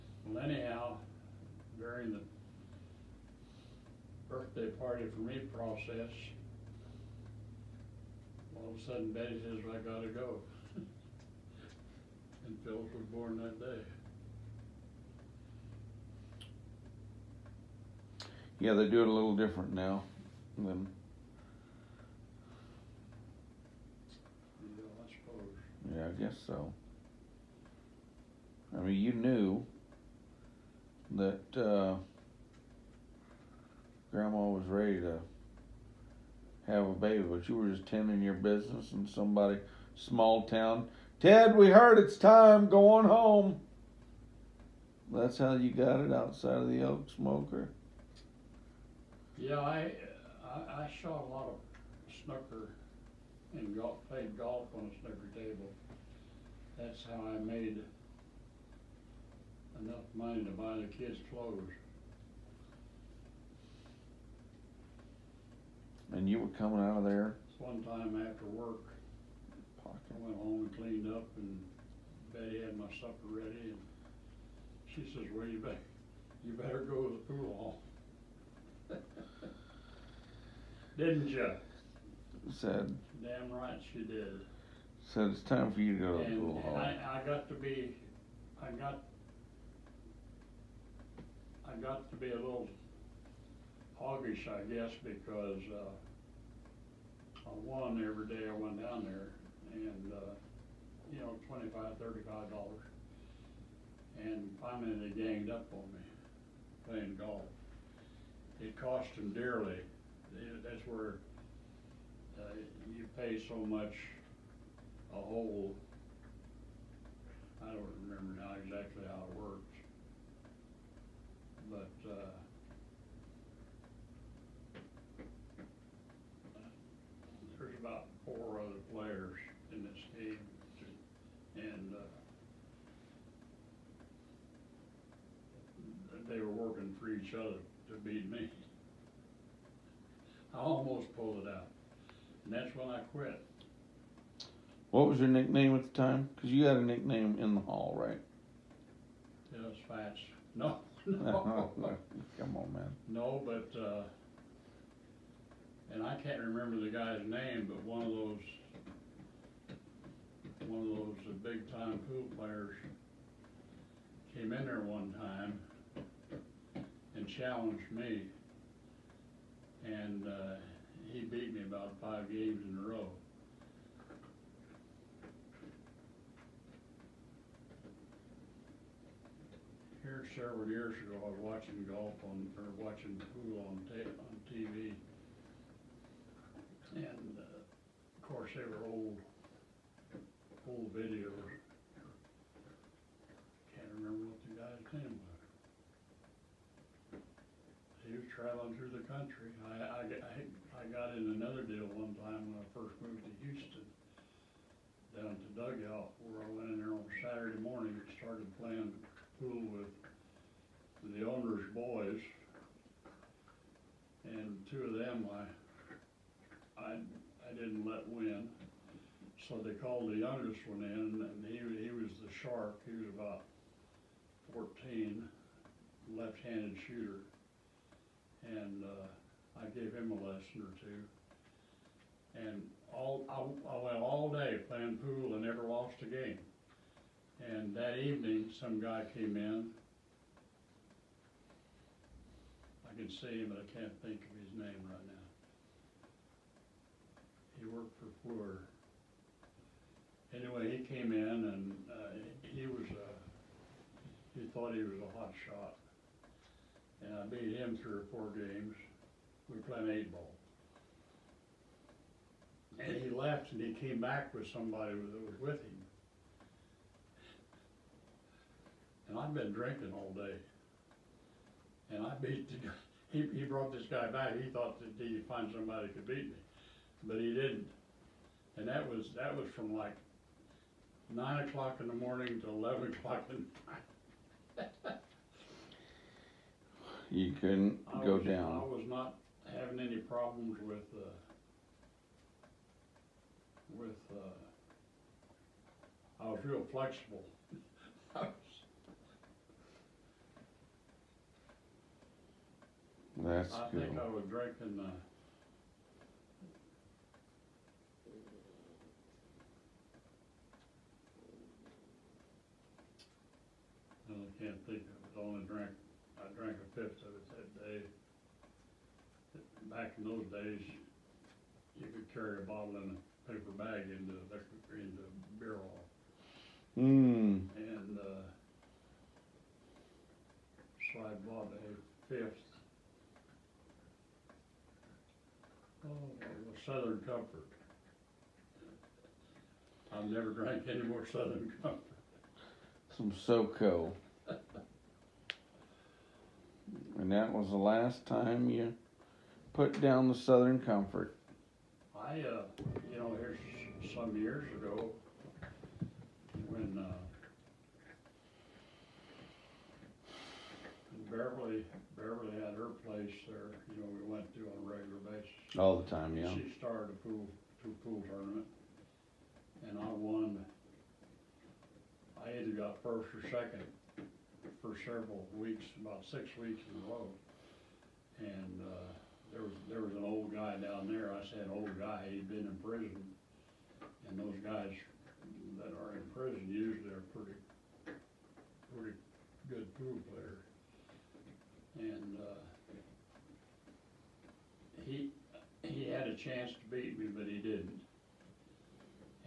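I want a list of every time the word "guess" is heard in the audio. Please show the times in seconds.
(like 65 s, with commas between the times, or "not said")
26 s, 94 s.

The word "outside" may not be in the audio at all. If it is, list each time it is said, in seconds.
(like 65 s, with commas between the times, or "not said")
46 s.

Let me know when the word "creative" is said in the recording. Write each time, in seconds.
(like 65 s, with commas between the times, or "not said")
not said.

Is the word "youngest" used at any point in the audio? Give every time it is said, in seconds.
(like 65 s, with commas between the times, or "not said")
220 s.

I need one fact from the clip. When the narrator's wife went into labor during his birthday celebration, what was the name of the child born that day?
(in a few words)
Philip.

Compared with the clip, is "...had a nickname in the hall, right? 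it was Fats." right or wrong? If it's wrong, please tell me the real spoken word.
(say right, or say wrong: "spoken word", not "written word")
right.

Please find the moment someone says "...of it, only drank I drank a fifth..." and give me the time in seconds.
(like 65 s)
314 s.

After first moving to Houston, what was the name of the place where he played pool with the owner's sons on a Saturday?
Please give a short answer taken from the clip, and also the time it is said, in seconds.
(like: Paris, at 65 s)
Dugout, at 205 s.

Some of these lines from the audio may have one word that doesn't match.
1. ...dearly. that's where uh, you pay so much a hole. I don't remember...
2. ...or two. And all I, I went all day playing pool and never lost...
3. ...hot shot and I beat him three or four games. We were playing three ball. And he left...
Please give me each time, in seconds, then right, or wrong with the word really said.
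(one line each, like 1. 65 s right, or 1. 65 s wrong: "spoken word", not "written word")
1. 109 s right
2. 230 s right
3. 255 s wrong: "eight", not "three".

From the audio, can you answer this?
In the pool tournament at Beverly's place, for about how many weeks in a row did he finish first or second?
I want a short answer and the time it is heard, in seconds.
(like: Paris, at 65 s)
6, at 376 s.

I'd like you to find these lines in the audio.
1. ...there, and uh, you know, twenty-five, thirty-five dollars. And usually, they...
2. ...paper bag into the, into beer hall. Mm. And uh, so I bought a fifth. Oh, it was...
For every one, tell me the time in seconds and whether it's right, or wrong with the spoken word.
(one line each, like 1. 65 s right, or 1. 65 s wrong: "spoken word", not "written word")
1. 99 s wrong: "finally", not "usually"
2. 323 s right.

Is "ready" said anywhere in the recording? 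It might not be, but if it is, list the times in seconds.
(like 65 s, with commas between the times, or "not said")
34 s, 73 s.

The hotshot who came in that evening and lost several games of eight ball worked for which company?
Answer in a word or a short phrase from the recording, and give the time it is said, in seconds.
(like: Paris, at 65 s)
Fluor, at 248 s.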